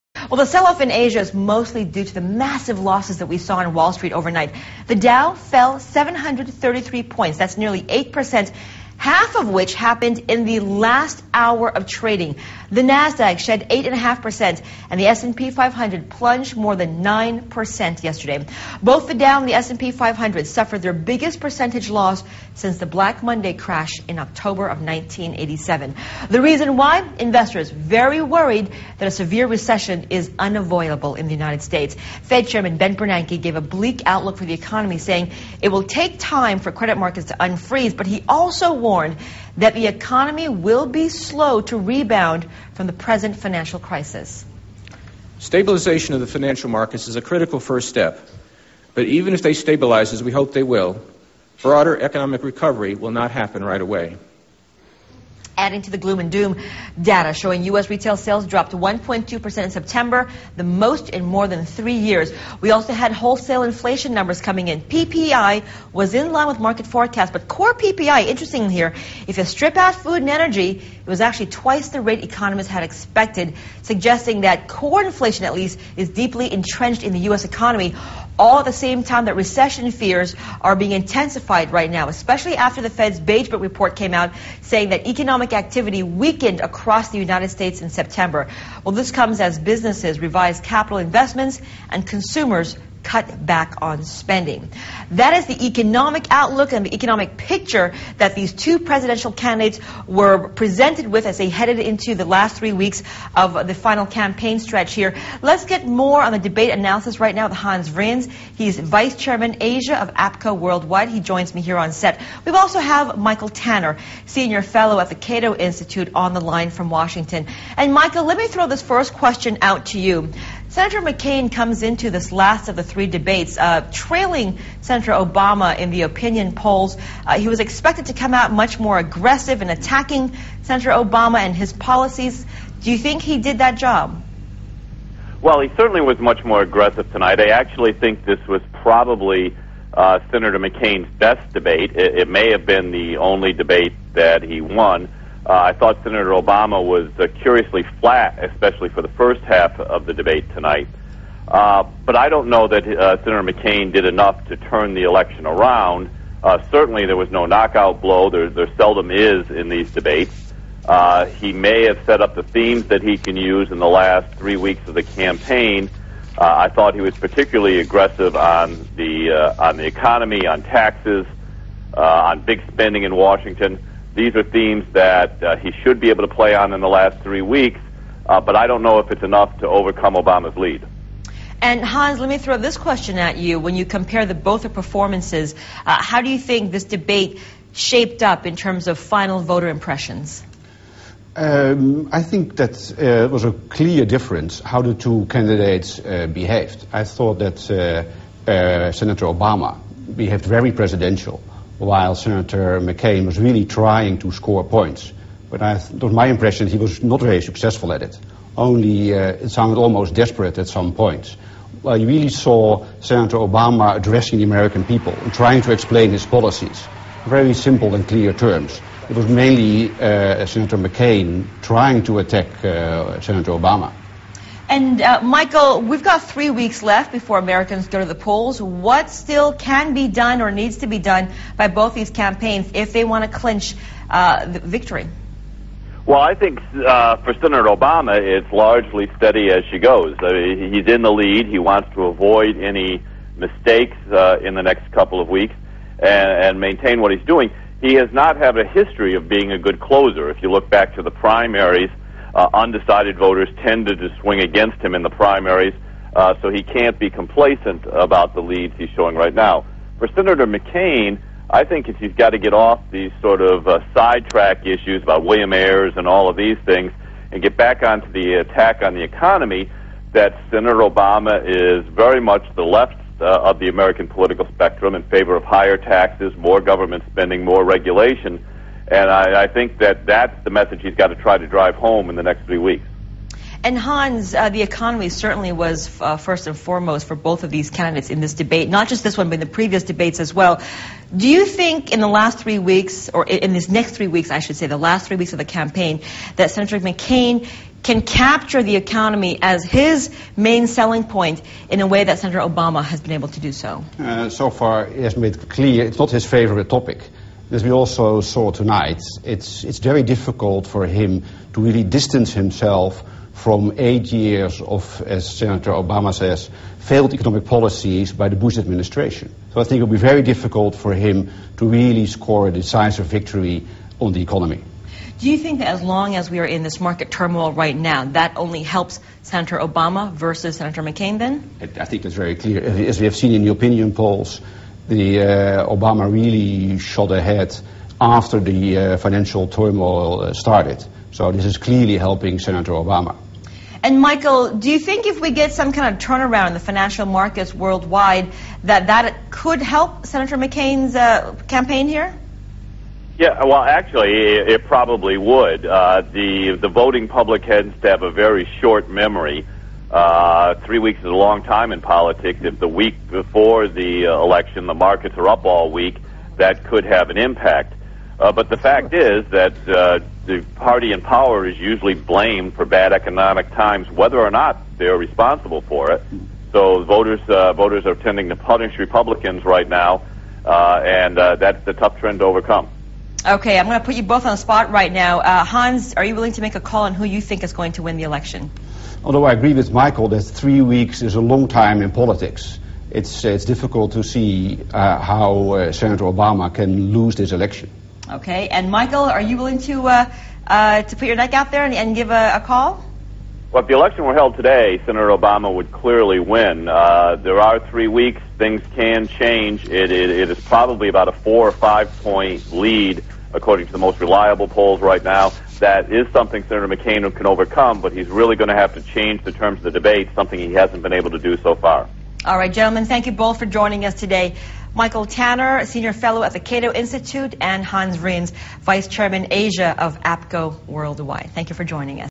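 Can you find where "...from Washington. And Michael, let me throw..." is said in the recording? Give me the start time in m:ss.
1:56.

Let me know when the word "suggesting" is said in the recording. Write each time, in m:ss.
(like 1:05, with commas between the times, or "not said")
1:13.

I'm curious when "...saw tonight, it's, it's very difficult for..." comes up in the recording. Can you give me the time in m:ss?
5:08.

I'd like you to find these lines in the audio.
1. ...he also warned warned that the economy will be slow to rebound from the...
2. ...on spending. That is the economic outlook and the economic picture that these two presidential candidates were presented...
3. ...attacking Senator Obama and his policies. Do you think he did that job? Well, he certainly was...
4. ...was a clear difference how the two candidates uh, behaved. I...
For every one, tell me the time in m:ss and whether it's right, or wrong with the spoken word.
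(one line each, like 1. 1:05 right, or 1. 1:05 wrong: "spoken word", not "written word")
1. 0:38 right
2. 1:33 right
3. 2:09 right
4. 3:13 right.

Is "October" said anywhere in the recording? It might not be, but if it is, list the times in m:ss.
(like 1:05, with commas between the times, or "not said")
0:24.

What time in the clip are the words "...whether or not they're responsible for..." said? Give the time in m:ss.
6:13.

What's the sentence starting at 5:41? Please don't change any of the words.
So this is clearly helping Senator Obama.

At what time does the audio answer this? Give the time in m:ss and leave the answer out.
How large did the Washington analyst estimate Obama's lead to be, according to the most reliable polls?
6:51.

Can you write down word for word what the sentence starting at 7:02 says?
All right, gentlemen, thank you both for joining us today.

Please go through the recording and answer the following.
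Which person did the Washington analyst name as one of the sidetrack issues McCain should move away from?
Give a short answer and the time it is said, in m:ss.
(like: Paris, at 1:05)
William Ayers, at 4:25.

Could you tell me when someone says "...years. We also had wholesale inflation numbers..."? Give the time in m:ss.
1:02.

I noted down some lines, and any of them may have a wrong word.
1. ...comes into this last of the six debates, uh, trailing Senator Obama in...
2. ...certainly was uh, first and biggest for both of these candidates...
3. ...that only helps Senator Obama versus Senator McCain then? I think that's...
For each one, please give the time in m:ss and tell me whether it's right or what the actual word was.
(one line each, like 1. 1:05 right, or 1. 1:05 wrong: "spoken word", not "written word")
1. 2:01 wrong: "three", not "six"
2. 4:45 wrong: "foremost", not "biggest"
3. 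5:28 right.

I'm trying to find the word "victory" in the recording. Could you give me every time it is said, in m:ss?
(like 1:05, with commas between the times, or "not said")
3:54, 5:23.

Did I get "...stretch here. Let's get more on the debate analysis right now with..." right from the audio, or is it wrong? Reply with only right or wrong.
right.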